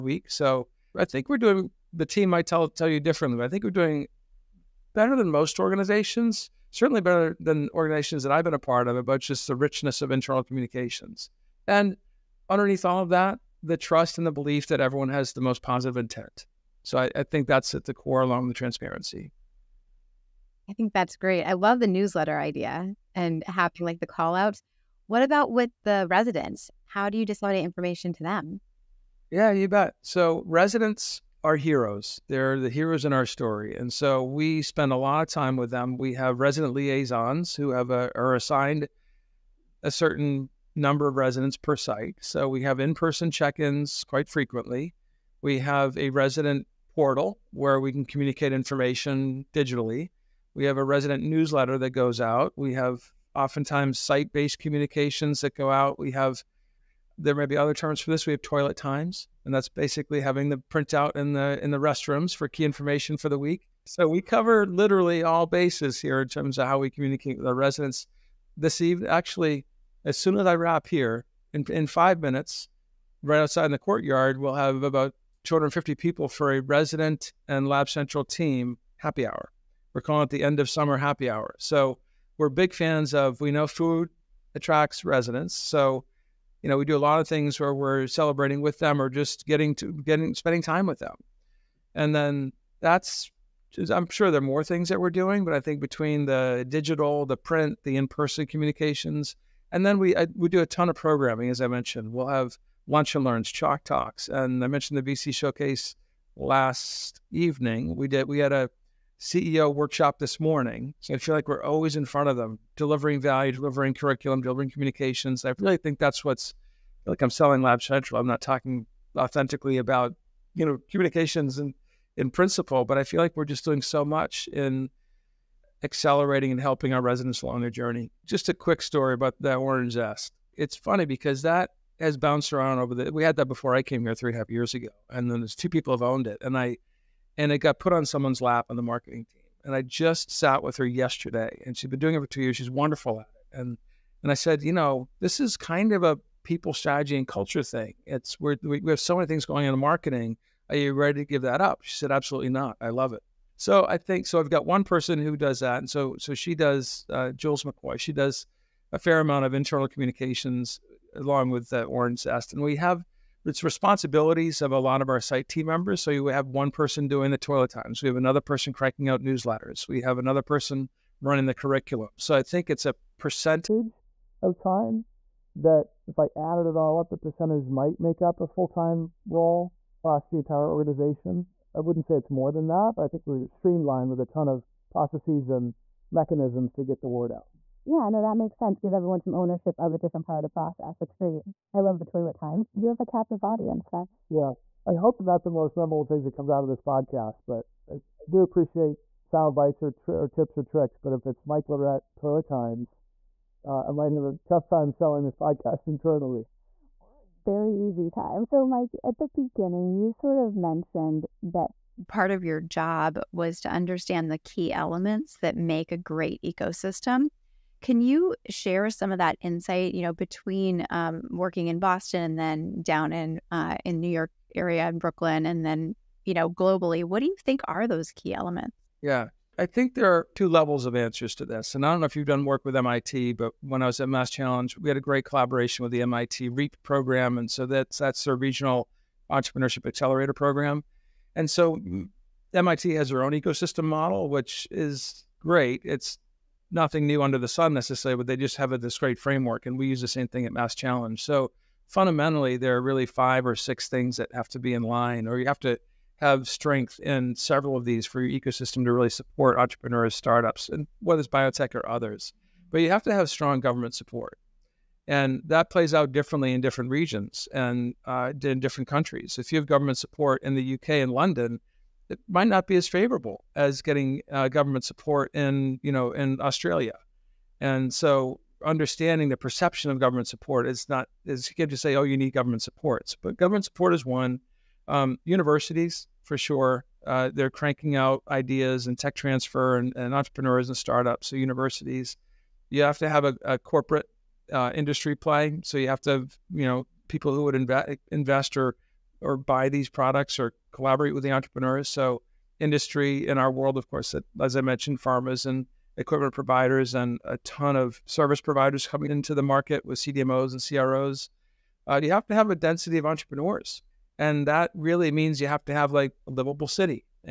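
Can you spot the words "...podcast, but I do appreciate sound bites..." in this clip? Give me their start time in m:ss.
3:16.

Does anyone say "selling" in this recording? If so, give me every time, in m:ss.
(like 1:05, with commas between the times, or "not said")
1:57, 3:24.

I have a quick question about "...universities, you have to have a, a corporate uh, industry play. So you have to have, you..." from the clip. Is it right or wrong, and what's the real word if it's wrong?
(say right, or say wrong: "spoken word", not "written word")
right.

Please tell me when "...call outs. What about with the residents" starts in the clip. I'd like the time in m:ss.
0:24.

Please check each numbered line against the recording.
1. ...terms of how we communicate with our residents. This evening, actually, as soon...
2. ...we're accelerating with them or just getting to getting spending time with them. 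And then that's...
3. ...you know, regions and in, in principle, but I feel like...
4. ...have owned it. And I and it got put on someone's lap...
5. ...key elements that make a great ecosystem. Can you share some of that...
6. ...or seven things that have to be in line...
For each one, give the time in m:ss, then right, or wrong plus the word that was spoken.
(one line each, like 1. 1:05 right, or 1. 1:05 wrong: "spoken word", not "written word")
1. 1:06 right
2. 1:27 wrong: "celebrating", not "accelerating"
3. 2:00 wrong: "communications", not "regions"
4. 2:15 right
5. 3:34 right
6. 4:13 wrong: "six", not "seven".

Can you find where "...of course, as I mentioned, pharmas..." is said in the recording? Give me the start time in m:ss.
5:03.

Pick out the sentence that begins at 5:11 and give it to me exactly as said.
Uh, you have to have a density of entrepreneurs.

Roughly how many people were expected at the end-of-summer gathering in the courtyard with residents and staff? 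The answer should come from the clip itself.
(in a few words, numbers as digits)
250.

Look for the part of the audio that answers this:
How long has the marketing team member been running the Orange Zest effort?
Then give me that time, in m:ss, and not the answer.
2:22.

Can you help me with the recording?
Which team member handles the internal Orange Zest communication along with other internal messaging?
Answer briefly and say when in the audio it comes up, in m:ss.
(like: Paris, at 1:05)
Jules McCoy, at 2:37.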